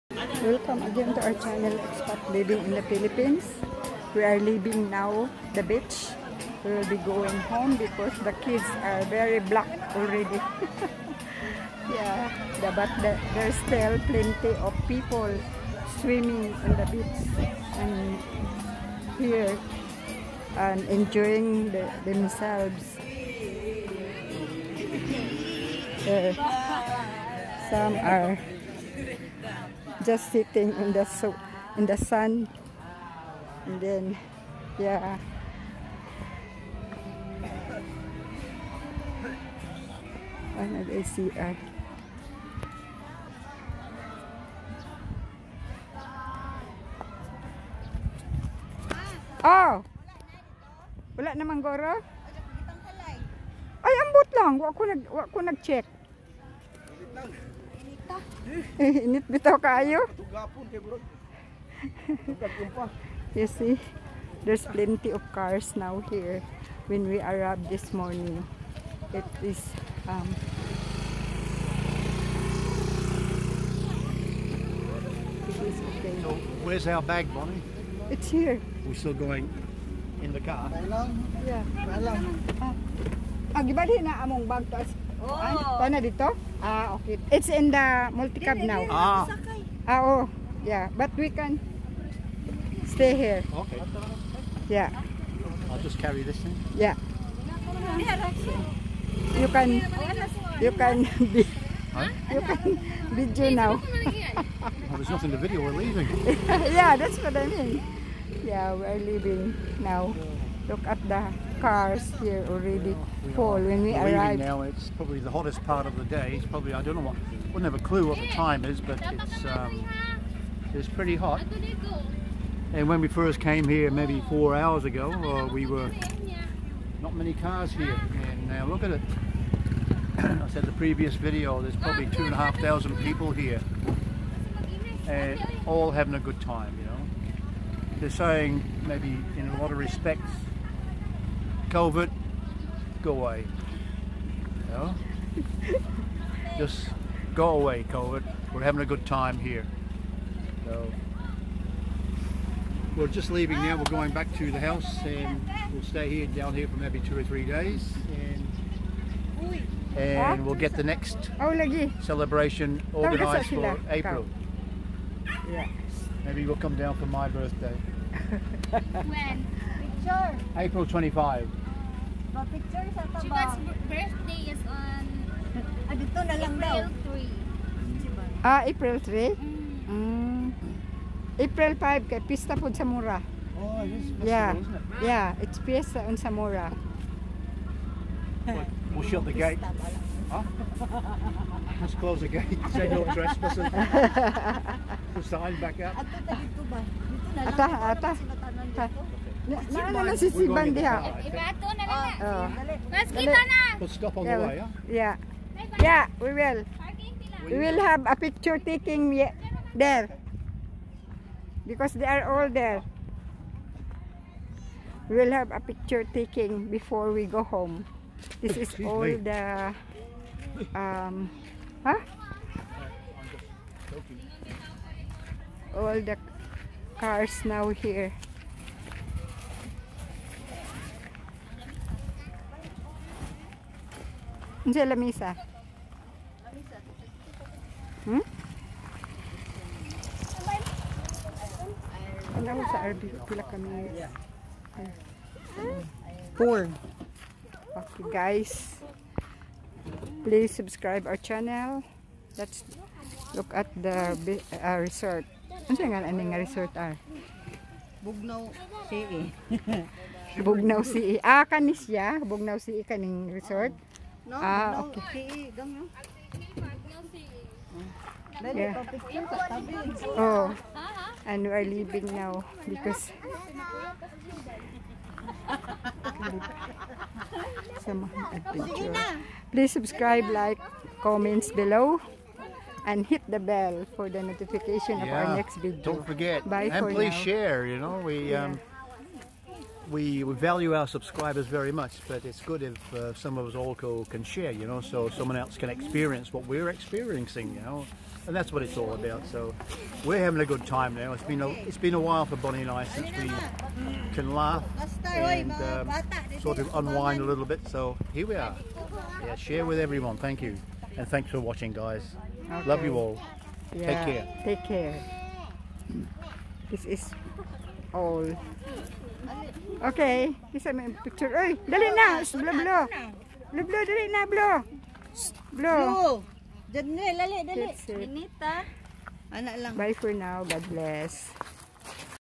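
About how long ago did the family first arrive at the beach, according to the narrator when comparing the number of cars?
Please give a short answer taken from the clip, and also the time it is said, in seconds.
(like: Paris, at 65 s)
4 hours, at 124 s.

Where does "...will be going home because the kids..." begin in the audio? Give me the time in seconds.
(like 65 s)
6 s.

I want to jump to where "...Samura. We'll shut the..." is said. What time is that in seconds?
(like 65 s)
186 s.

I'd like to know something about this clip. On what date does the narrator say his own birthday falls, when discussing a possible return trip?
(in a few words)
April 25.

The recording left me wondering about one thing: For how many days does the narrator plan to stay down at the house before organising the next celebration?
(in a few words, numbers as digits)
2 or 3 days.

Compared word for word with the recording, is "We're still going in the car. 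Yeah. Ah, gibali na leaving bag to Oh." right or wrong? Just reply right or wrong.
wrong.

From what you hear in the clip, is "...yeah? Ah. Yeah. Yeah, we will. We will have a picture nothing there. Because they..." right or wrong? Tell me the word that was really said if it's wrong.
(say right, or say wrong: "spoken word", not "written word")
wrong: "taking", not "nothing".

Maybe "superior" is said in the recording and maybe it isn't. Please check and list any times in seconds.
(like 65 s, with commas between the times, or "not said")
not said.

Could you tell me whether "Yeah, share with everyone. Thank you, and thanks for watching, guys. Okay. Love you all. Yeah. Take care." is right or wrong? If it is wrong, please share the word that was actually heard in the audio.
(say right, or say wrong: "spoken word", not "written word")
right.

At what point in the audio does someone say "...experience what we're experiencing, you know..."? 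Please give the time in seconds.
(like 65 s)
295 s.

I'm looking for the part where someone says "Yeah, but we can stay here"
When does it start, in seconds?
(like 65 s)
90 s.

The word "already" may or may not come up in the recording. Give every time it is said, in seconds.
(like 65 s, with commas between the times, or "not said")
9 s, 112 s.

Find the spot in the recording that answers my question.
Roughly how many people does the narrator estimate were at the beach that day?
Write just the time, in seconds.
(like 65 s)
132 s.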